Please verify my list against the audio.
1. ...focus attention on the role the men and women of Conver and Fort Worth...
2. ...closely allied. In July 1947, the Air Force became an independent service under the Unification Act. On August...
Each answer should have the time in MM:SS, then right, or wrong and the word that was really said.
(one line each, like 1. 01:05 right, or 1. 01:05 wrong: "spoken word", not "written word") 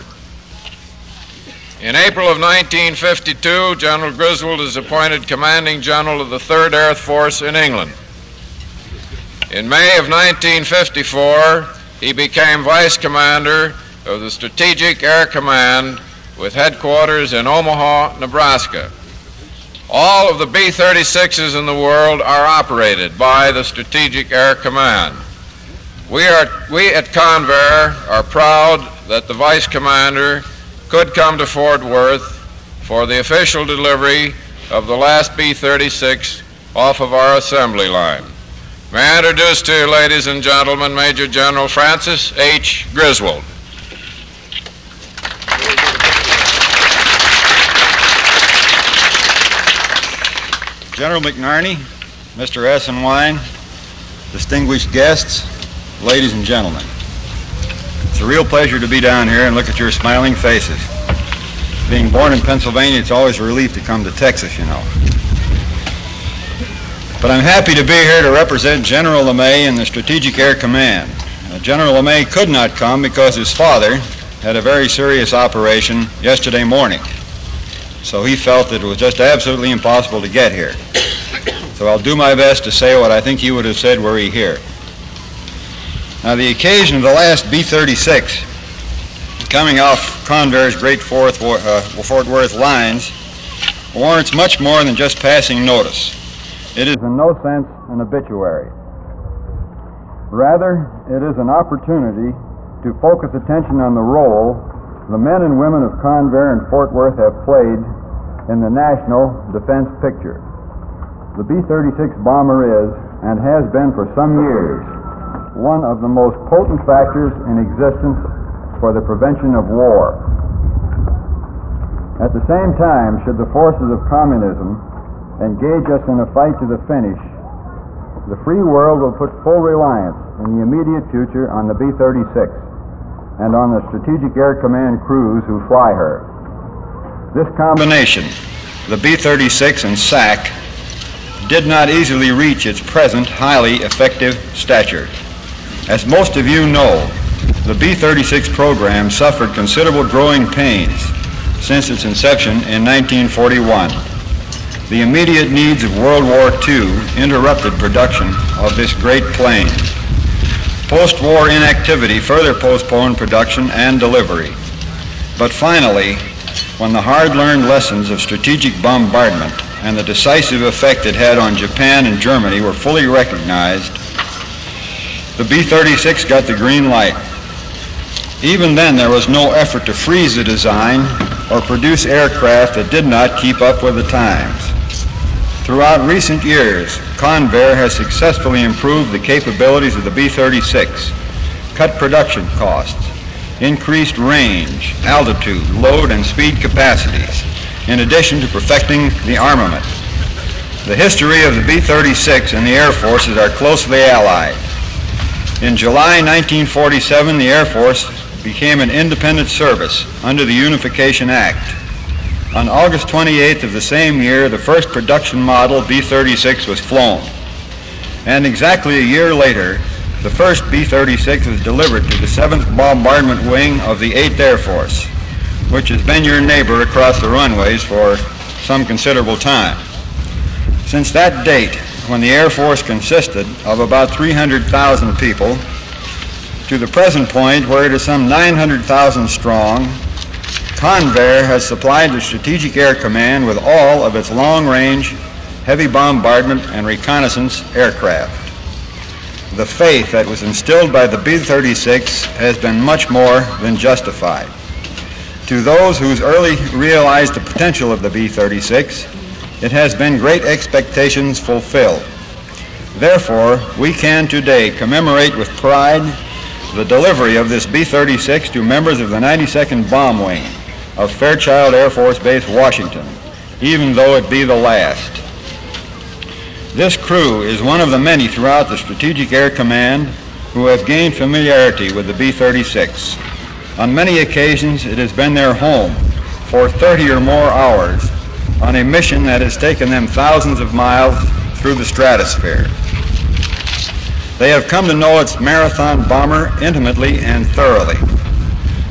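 1. 01:42 right
2. 03:23 right.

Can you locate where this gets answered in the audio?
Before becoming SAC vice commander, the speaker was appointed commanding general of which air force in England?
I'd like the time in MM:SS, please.
00:06.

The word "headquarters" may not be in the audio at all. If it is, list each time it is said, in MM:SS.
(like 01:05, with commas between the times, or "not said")
00:16.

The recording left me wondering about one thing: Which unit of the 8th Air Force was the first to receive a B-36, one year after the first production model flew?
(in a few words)
7th Bombardment Wing.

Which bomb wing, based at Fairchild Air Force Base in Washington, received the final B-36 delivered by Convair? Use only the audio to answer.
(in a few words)
92nd Bomb Wing.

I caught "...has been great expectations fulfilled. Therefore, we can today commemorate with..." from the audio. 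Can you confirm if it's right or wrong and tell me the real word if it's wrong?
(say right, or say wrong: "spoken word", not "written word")
right.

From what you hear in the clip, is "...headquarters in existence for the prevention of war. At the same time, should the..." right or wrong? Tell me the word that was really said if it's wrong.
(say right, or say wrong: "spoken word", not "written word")
wrong: "factors", not "headquarters".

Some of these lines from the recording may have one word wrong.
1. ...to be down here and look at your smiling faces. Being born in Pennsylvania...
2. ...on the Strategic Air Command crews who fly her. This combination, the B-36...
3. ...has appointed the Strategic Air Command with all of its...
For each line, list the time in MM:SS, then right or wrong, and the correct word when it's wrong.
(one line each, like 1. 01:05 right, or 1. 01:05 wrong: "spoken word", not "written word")
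1. 00:58 right
2. 02:13 right
3. 04:01 wrong: "supplied", not "appointed".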